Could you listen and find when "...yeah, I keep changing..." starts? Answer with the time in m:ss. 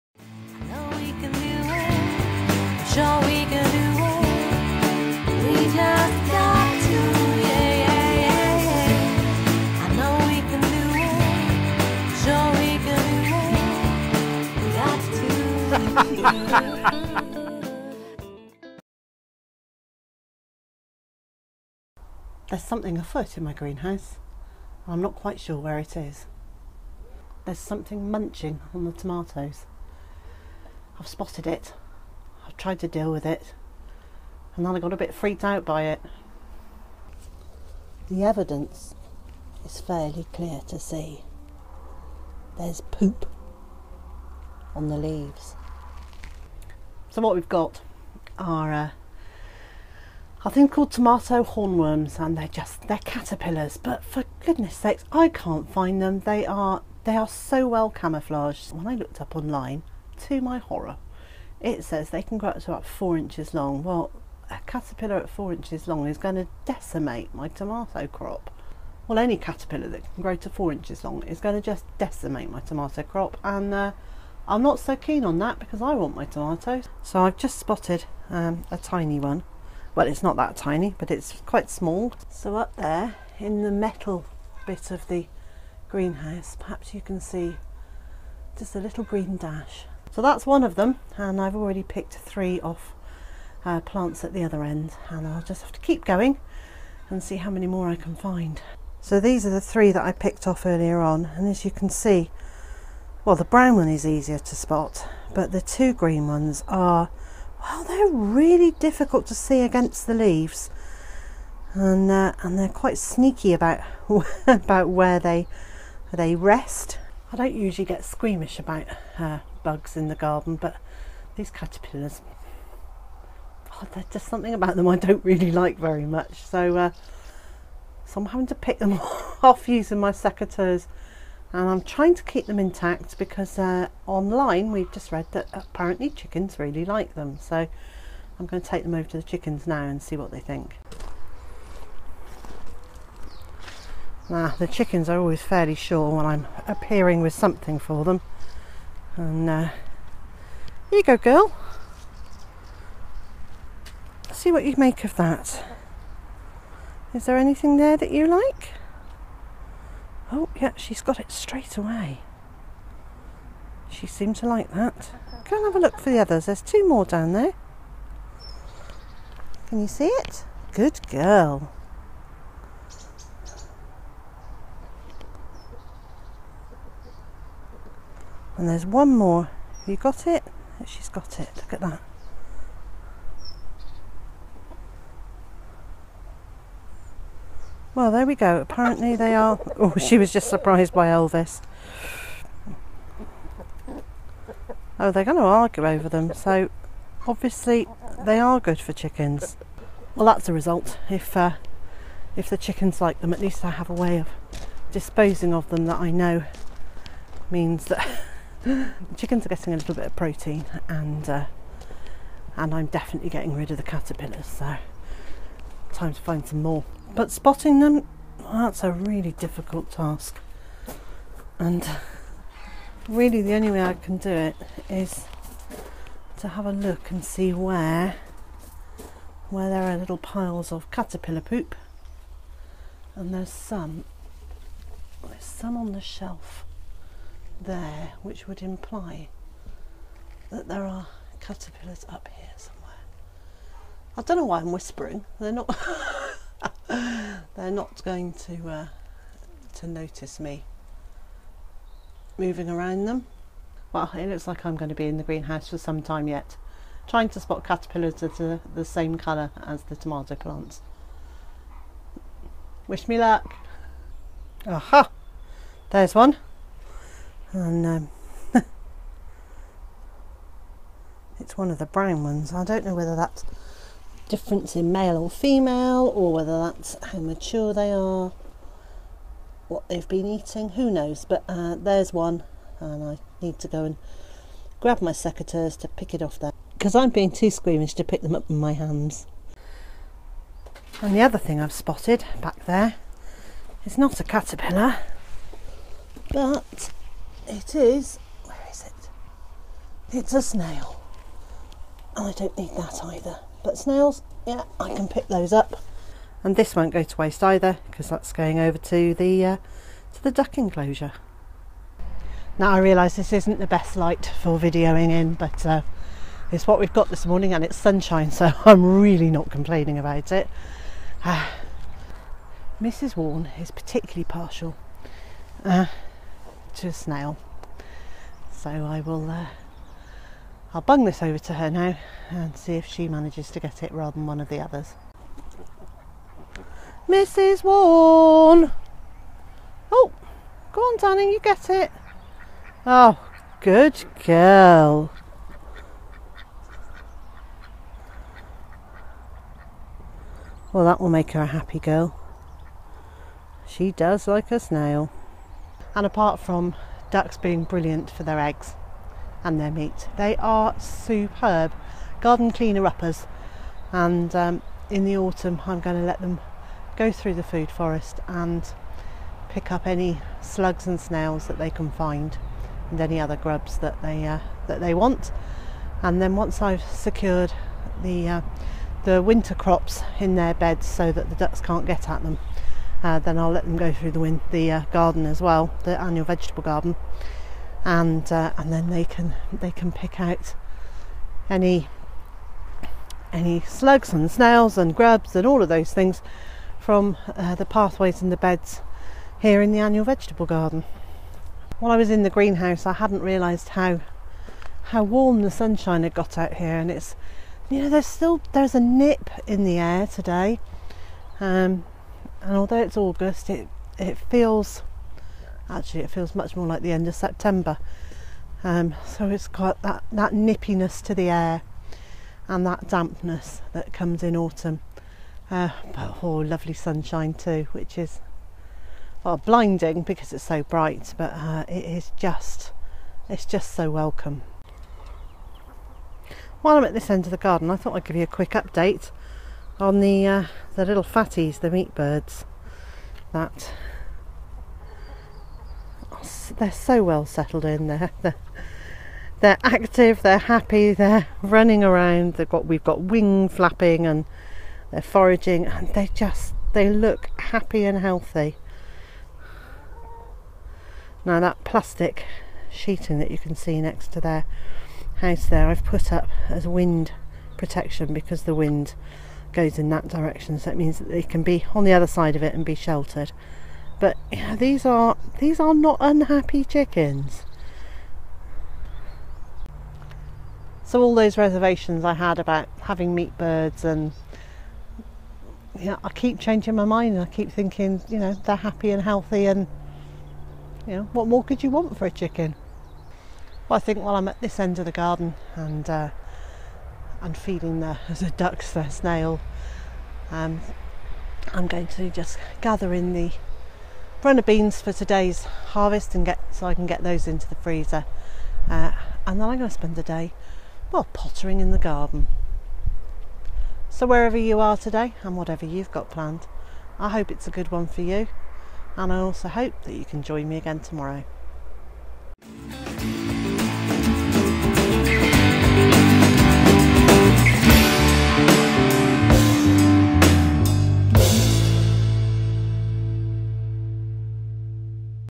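8:05.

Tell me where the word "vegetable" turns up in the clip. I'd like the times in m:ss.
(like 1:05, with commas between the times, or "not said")
6:26, 6:40.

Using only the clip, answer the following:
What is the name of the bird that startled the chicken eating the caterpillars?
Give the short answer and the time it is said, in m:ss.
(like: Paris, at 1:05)
Elvis, at 3:11.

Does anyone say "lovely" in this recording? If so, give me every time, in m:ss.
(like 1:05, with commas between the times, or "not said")
7:06.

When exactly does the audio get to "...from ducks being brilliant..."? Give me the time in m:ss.
5:56.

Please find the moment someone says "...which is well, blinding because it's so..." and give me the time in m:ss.
7:07.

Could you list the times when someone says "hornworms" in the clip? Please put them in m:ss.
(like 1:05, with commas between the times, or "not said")
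0:51.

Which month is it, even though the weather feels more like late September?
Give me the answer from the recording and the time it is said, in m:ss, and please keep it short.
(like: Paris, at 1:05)
August, at 6:52.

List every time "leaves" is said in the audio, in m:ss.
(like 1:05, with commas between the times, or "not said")
0:44, 1:50.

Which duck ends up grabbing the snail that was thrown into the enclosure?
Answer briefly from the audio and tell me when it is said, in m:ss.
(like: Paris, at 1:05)
Danny, at 5:40.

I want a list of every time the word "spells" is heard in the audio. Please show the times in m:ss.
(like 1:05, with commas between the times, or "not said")
not said.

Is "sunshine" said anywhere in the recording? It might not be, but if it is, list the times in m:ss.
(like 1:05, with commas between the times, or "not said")
5:17, 6:45, 7:06.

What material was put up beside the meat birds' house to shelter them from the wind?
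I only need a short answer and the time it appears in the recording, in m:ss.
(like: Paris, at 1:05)
plastic sheeting, at 7:41.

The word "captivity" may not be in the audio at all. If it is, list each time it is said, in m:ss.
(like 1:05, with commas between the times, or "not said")
not said.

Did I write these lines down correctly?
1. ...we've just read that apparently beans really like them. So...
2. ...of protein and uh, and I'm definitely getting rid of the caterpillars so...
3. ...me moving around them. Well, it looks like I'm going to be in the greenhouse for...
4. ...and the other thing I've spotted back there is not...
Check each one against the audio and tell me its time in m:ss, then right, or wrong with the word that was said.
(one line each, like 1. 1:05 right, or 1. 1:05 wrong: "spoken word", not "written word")
1. 2:14 wrong: "chickens", not "beans"
2. 3:30 right
3. 4:10 right
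4. 4:51 right.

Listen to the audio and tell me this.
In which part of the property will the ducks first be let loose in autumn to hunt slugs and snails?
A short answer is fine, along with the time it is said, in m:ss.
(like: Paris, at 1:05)
food forest, at 6:07.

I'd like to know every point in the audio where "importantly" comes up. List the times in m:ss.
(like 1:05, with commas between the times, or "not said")
not said.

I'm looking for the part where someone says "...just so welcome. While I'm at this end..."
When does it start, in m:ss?
7:13.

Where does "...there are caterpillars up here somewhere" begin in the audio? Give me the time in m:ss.
4:00.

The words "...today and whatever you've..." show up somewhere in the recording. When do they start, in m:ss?
8:34.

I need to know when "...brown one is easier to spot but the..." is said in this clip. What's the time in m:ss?
1:43.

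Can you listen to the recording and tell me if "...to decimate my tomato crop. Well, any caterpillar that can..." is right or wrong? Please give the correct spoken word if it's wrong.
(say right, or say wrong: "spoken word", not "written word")
right.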